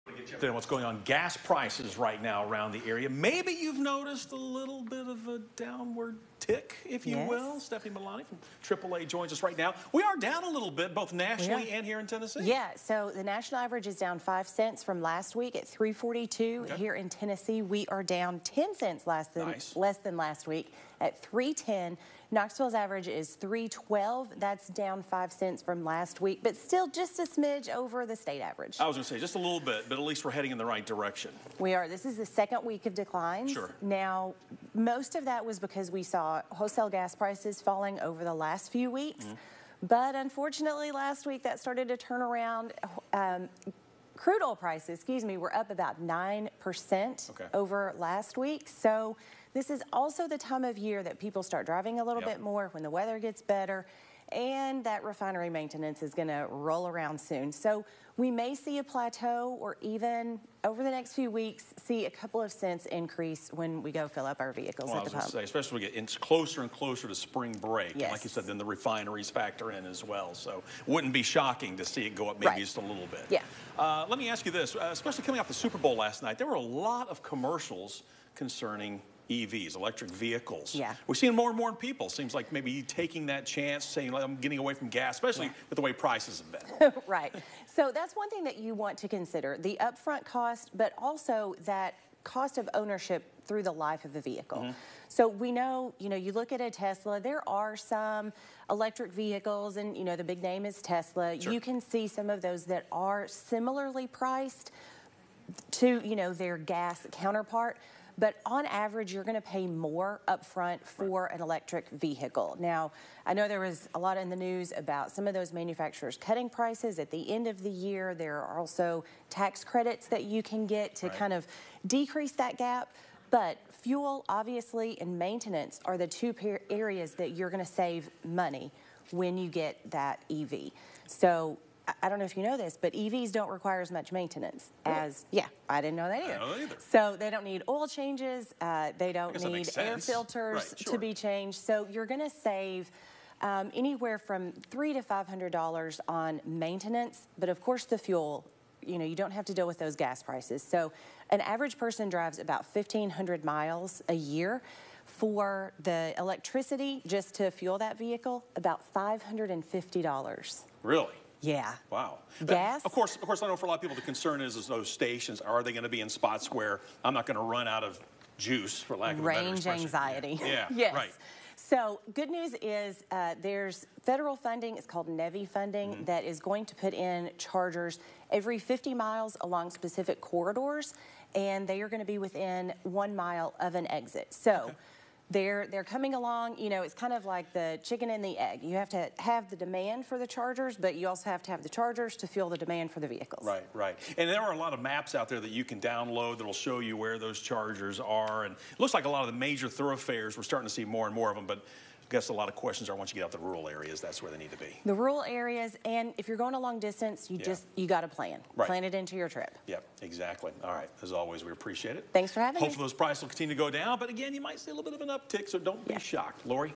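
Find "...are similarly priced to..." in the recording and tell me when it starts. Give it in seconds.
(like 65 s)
102 s.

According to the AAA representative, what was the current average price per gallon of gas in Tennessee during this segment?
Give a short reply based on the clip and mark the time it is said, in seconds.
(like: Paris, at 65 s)
$3.10, at 21 s.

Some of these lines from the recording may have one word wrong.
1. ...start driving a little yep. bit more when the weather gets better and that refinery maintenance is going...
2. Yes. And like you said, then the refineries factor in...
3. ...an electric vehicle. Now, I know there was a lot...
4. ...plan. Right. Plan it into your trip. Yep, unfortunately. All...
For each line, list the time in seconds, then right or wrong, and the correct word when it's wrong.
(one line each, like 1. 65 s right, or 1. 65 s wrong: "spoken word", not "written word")
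1. 51 s right
2. 67 s right
3. 111 s right
4. 208 s wrong: "exactly", not "unfortunately".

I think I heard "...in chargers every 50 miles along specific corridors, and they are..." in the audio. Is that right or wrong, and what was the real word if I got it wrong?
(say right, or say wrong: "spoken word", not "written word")
right.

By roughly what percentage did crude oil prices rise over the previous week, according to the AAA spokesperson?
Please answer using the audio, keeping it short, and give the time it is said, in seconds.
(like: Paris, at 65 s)
9%, at 45 s.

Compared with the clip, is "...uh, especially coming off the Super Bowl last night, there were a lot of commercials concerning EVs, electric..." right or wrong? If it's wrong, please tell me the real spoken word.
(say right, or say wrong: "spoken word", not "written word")
right.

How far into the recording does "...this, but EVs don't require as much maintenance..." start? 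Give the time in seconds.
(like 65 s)
132 s.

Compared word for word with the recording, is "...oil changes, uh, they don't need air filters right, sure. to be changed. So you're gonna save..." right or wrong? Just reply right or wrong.
right.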